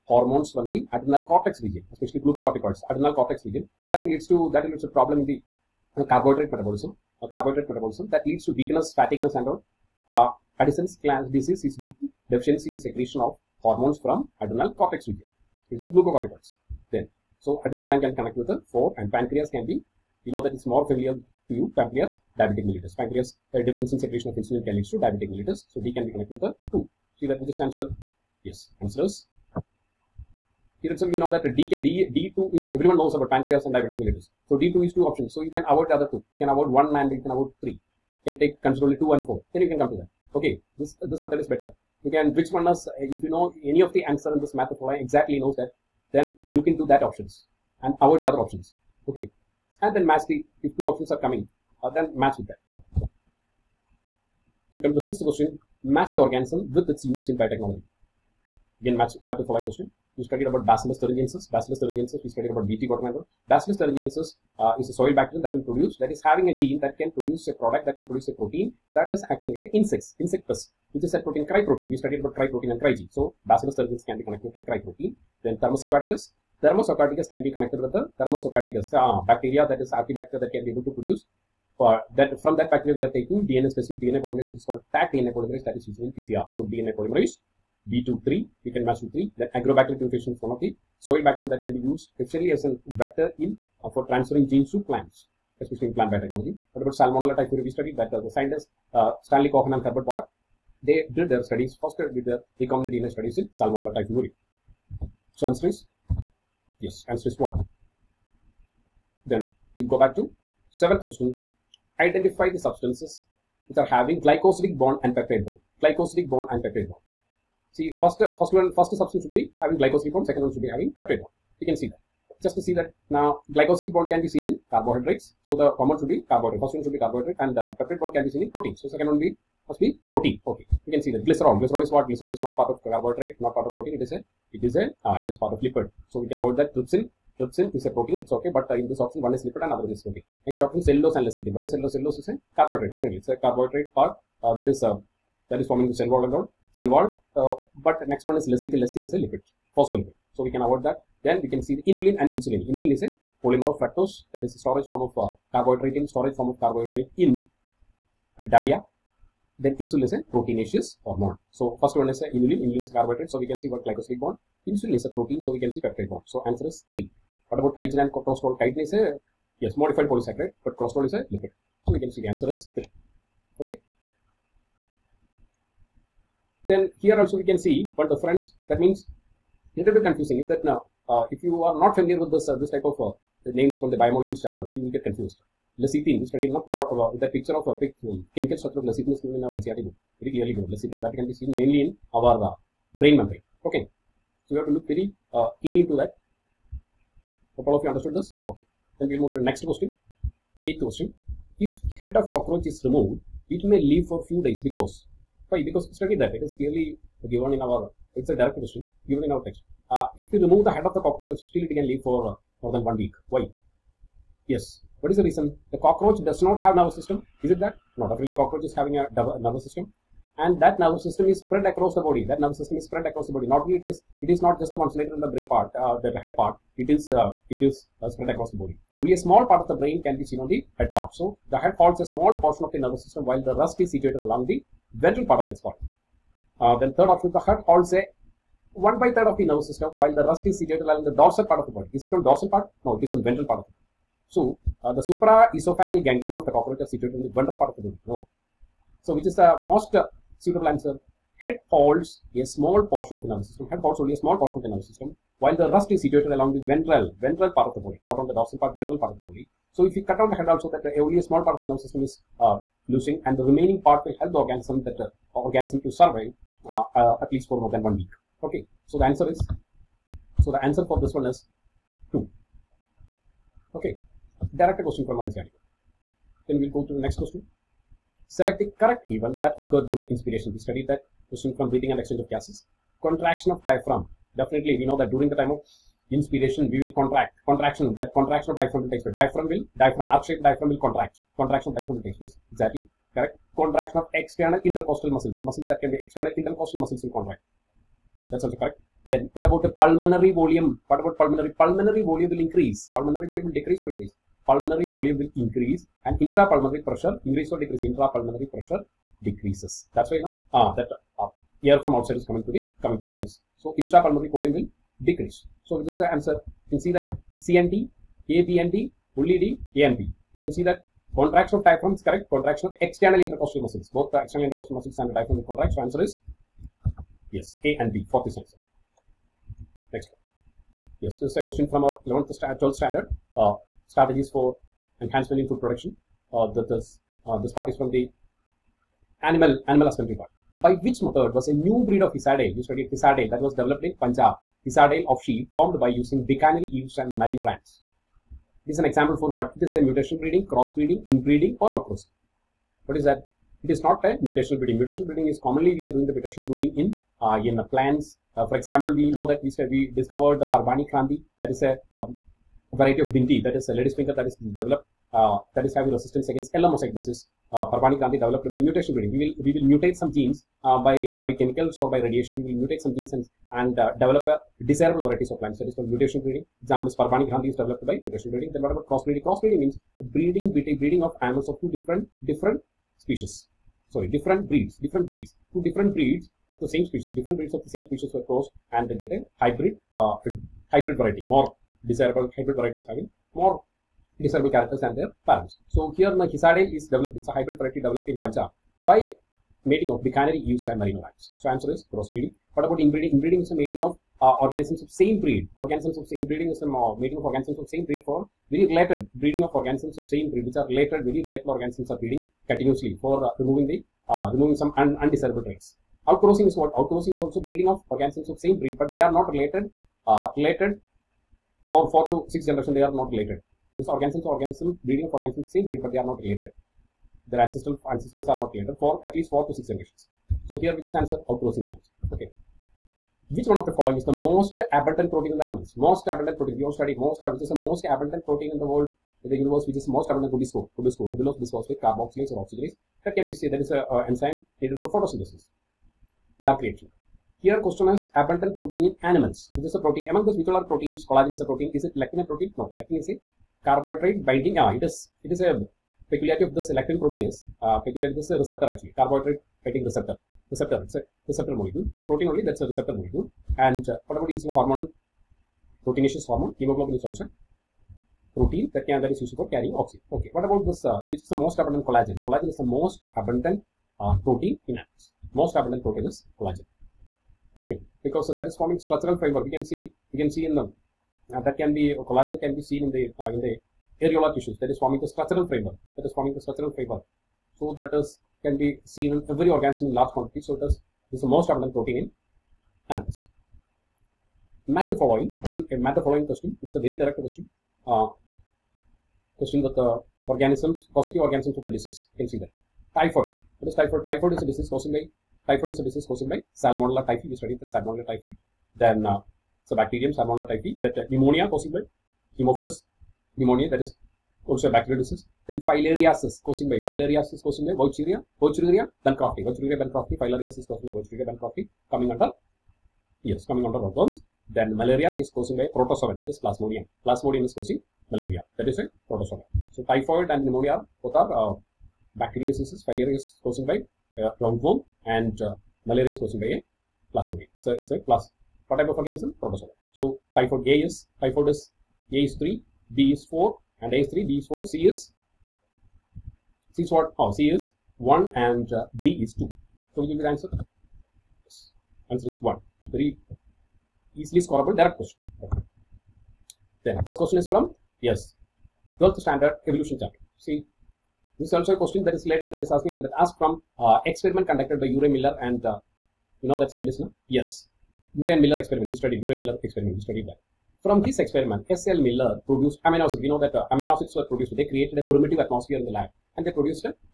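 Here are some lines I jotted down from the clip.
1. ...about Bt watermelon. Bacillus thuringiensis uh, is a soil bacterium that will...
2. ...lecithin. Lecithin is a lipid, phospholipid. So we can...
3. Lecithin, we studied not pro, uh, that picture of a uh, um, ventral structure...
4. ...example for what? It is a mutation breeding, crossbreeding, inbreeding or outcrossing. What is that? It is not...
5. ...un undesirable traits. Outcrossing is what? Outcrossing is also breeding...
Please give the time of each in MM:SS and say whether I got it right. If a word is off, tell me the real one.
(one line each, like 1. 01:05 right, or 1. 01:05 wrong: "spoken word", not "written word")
1. 01:02 right
2. 02:28 right
3. 03:05 wrong: "chemical", not "ventral"
4. 05:48 right
5. 06:54 right.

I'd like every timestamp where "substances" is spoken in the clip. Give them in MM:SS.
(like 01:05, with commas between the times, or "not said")
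01:52, 01:58.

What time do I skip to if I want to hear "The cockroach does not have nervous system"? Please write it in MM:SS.
03:35.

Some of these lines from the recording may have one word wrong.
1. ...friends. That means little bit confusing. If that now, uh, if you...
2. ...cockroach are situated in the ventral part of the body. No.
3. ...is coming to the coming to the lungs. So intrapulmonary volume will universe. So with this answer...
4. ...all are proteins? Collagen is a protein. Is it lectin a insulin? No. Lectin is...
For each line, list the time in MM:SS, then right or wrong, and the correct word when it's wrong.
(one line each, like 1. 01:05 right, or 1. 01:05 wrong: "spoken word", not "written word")
1. 02:58 right
2. 04:06 right
3. 05:12 wrong: "decrease", not "universe"
4. 07:30 wrong: "protein", not "insulin".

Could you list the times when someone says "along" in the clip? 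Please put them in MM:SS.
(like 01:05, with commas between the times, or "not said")
03:54, 04:00, 04:16.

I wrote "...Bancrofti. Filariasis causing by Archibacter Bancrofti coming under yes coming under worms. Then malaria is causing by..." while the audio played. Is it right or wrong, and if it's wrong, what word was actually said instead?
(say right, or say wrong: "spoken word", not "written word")
wrong: "Wuchereria", not "Archibacter".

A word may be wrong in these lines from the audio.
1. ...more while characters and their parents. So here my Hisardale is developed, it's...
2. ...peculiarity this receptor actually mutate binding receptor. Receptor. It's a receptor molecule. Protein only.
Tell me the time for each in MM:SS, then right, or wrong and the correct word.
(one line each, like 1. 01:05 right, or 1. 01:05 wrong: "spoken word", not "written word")
1. 06:33 wrong: "desirable", not "while"
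2. 07:37 wrong: "carbohydrate", not "mutate".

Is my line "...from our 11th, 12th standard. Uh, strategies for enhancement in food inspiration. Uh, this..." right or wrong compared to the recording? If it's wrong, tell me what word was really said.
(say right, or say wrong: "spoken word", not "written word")
wrong: "production", not "inspiration".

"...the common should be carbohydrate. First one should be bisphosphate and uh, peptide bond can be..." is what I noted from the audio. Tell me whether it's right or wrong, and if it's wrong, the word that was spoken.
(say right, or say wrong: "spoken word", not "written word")
wrong: "carbohydrate", not "bisphosphate".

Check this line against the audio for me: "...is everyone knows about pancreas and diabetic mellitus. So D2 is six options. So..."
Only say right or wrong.
wrong.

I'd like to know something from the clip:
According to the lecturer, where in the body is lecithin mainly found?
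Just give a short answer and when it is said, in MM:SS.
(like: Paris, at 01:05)
Brain membrane, at 03:12.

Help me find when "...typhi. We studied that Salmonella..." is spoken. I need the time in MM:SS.
08:27.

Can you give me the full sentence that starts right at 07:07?
Their ancestral ancestors are not related for at least four to six generations.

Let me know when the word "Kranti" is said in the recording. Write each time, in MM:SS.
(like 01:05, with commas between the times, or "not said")
06:00, 06:07, 06:17.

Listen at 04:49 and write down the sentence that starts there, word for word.
Diaphragm will, diaphragm, arc-shaped diaphragm will contract.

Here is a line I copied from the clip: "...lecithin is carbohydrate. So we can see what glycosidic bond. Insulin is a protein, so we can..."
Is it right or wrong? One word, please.
wrong.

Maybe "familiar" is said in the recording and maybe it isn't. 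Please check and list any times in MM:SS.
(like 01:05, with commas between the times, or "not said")
00:20, 03:01.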